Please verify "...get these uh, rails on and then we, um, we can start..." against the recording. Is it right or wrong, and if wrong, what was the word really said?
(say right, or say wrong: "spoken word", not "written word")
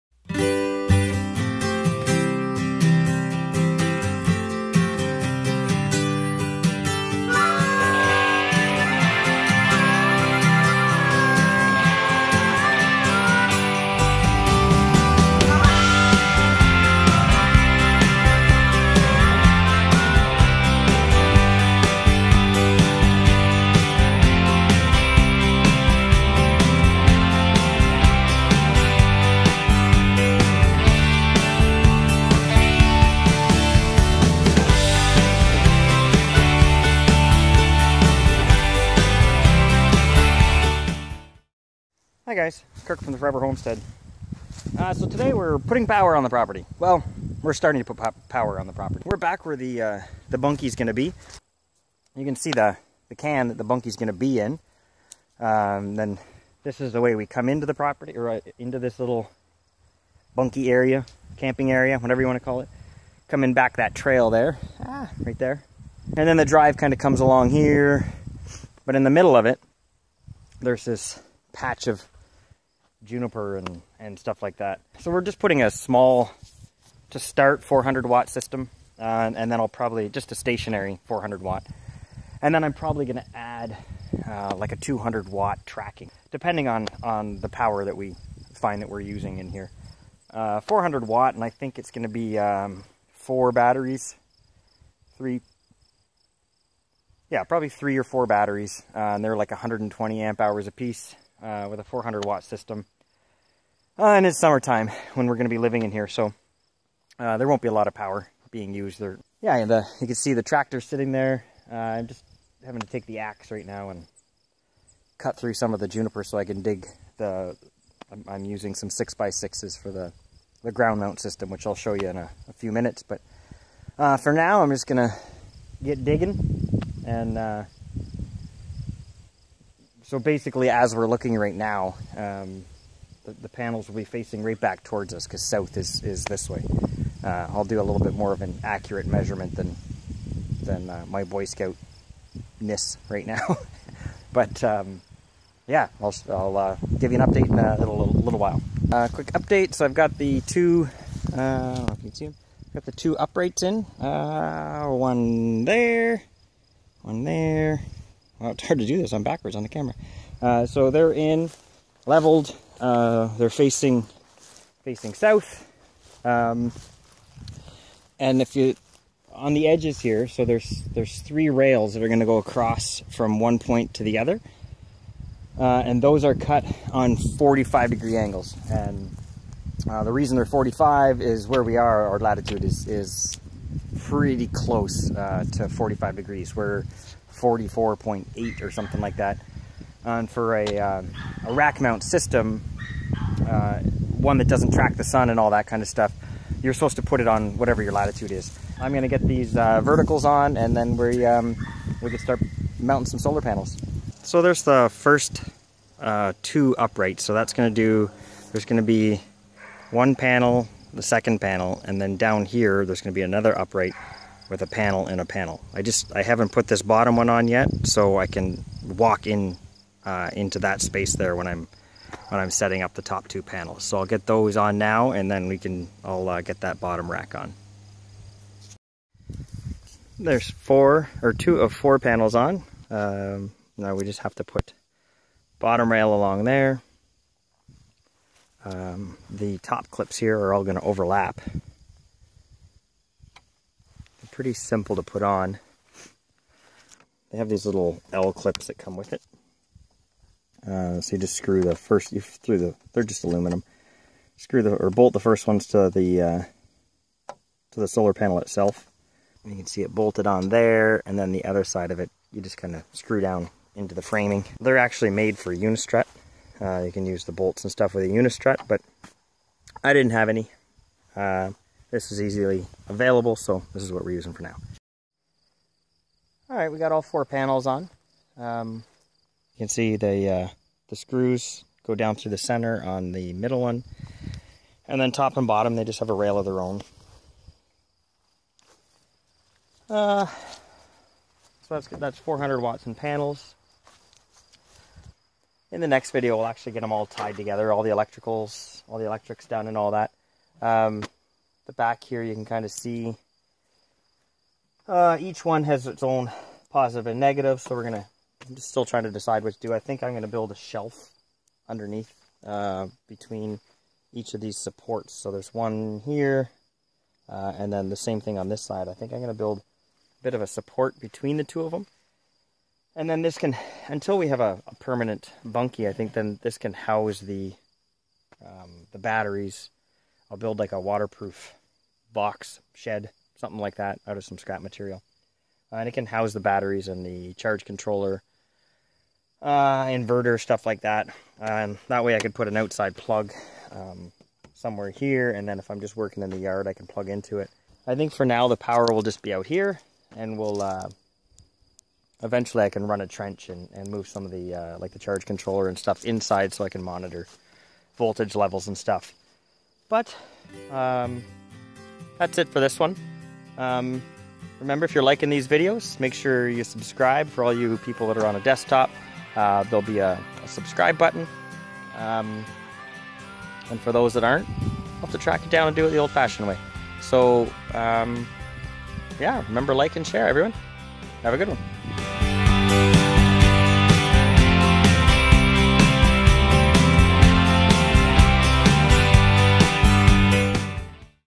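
wrong: "verticals", not "rails".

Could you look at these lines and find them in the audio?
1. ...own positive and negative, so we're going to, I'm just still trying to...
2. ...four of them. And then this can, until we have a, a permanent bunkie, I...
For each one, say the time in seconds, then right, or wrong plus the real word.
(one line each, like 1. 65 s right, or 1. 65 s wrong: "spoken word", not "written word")
1. 306 s right
2. 321 s wrong: "two", not "four".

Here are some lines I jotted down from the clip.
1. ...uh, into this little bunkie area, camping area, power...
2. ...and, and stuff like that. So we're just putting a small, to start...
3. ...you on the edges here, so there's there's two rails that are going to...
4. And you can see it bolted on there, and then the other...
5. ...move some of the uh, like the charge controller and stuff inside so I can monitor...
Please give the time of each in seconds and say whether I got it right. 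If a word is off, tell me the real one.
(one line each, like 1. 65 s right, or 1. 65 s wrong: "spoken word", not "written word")
1. 58 s wrong: "whatever", not "power"
2. 73 s right
3. 168 s wrong: "three", not "two"
4. 259 s right
5. 353 s right.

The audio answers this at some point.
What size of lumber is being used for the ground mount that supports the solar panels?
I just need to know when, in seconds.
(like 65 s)
118 s.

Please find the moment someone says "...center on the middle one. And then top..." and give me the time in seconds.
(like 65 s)
282 s.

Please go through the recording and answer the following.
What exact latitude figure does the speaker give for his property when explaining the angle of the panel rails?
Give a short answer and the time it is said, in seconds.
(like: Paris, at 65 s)
44.8, at 187 s.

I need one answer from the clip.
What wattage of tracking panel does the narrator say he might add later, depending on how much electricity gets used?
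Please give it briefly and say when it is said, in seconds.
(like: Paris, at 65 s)
200 watts, at 84 s.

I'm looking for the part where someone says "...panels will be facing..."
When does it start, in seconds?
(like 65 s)
133 s.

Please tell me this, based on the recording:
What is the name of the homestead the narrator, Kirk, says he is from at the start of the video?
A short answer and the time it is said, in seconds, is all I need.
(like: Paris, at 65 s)
Forever Homestead, at 43 s.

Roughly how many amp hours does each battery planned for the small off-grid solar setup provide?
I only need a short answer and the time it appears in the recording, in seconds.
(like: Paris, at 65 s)
120, at 99 s.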